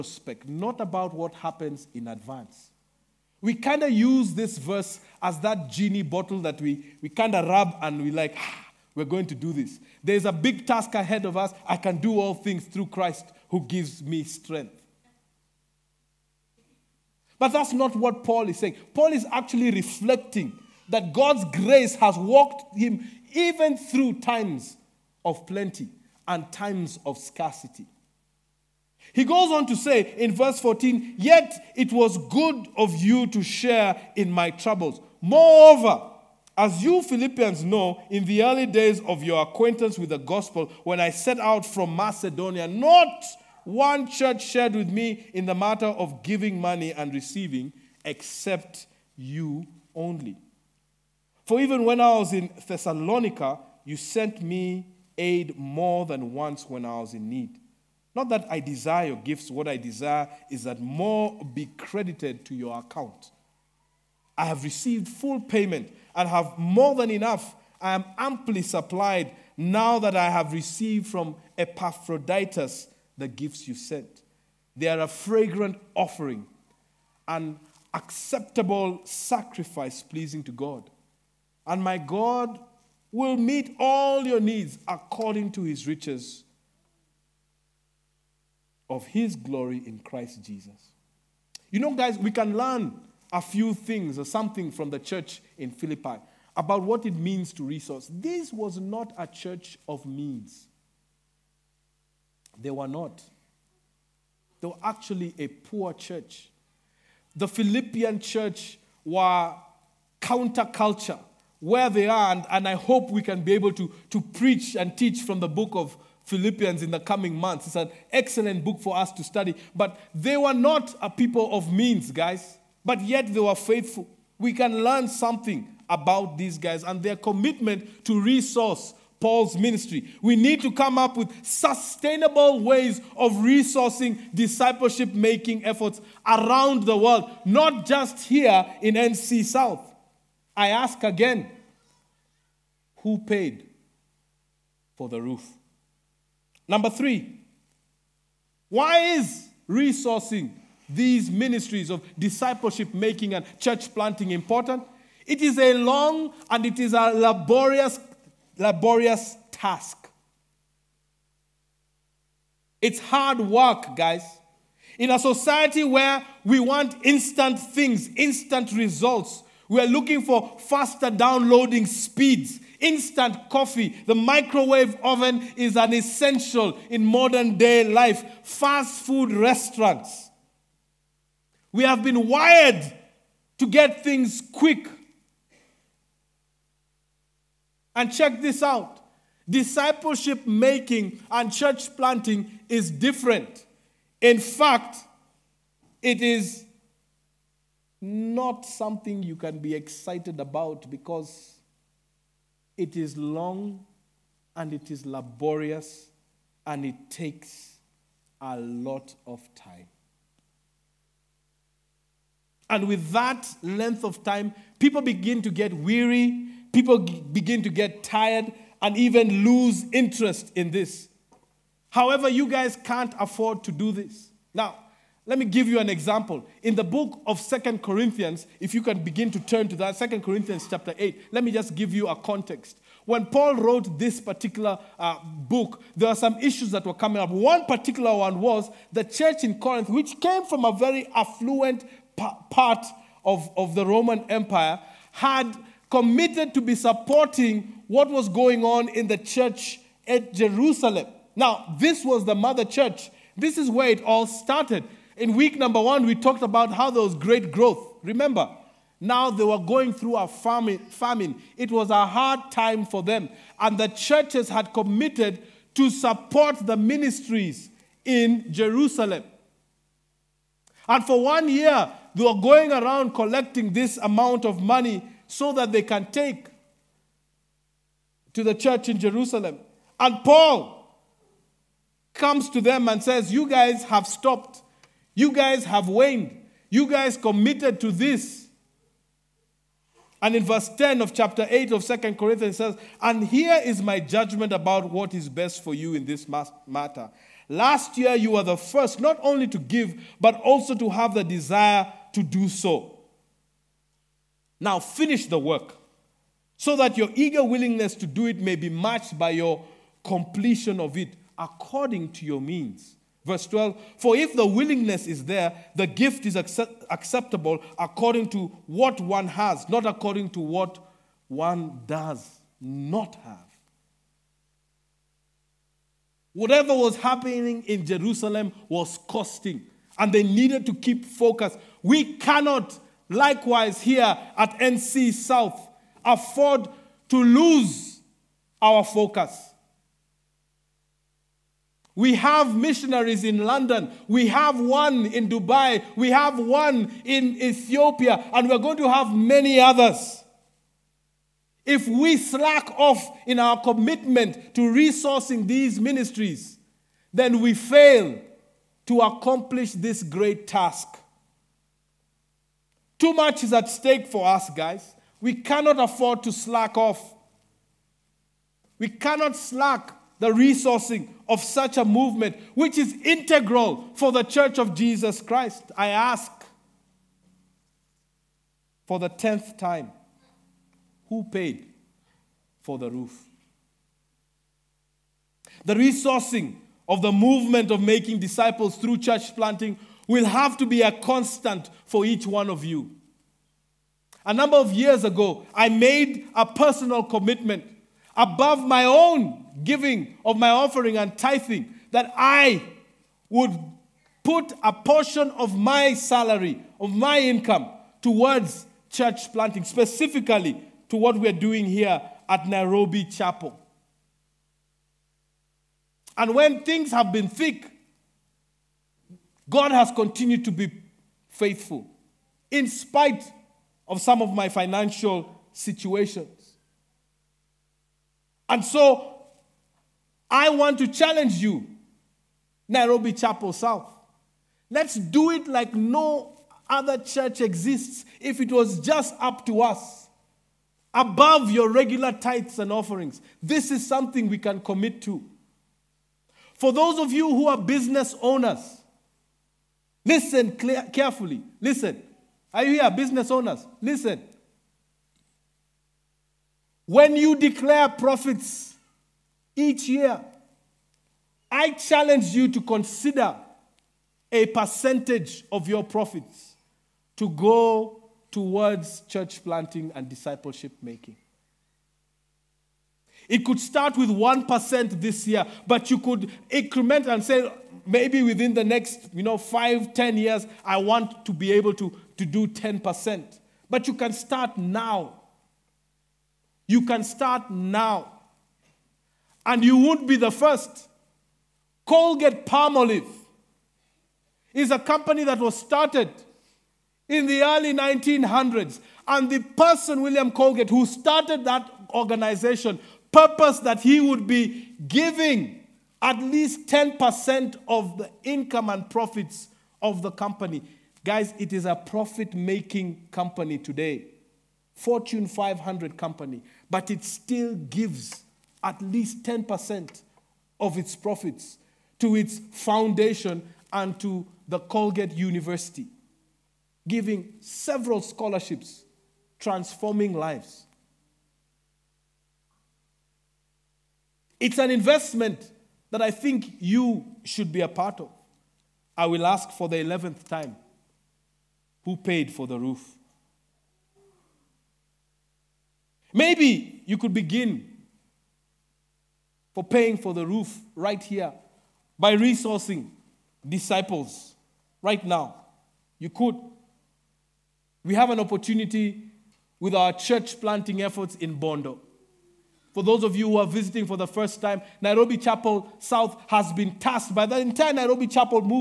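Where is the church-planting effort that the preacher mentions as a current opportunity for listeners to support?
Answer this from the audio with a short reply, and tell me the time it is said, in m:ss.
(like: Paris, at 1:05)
Bondo, at 9:21.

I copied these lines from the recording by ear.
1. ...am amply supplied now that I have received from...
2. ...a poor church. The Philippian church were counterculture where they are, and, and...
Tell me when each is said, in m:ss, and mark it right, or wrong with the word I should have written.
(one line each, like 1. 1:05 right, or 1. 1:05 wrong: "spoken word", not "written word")
1. 1:07 right
2. 1:45 right.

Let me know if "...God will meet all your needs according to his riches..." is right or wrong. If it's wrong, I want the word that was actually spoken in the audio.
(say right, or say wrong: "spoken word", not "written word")
right.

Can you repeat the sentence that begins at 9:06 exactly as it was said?
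Maybe you could begin for paying for the roof right here by resourcing disciples right now.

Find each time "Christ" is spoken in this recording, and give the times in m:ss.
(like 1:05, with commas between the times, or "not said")
0:12, 1:29, 6:15.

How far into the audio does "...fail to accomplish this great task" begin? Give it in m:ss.
5:57.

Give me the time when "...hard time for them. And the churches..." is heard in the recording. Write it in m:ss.
4:22.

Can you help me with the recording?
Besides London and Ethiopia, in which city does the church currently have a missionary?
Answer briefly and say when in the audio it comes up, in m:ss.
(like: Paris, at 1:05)
Dubai, at 5:45.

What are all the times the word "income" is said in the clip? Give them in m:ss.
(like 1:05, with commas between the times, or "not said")
6:47, 8:28.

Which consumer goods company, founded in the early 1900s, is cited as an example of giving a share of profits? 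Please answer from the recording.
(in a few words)
Colgate Palmolive.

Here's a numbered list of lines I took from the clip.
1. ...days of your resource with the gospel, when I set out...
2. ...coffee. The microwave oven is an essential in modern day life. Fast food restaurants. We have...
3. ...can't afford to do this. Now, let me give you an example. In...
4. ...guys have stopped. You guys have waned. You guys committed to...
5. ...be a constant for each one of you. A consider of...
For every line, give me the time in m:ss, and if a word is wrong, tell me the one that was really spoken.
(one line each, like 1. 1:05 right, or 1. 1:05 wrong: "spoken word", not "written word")
1. 0:38 wrong: "acquaintance", not "resource"
2. 2:53 right
3. 3:42 right
4. 4:43 right
5. 6:30 wrong: "number", not "consider".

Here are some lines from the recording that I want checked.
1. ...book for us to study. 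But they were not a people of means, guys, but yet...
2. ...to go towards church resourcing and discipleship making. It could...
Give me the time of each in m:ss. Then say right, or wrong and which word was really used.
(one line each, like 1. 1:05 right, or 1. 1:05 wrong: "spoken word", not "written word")
1. 1:58 right
2. 7:47 wrong: "planting", not "resourcing".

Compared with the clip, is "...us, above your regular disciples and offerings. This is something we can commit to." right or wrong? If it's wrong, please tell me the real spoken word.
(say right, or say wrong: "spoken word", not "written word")
wrong: "tithes", not "disciples".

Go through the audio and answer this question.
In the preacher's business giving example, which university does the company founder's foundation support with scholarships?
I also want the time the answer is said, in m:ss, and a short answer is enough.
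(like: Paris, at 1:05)
Colgate University, at 8:44.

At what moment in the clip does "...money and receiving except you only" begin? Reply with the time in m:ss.
0:46.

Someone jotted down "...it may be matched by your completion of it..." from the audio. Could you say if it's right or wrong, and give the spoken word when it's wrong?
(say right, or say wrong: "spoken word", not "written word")
right.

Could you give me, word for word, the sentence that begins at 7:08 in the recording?
And so I want to challenge you, Nairobi Chapel South.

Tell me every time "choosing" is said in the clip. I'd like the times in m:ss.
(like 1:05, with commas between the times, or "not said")
not said.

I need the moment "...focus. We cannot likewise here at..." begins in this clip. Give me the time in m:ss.
5:31.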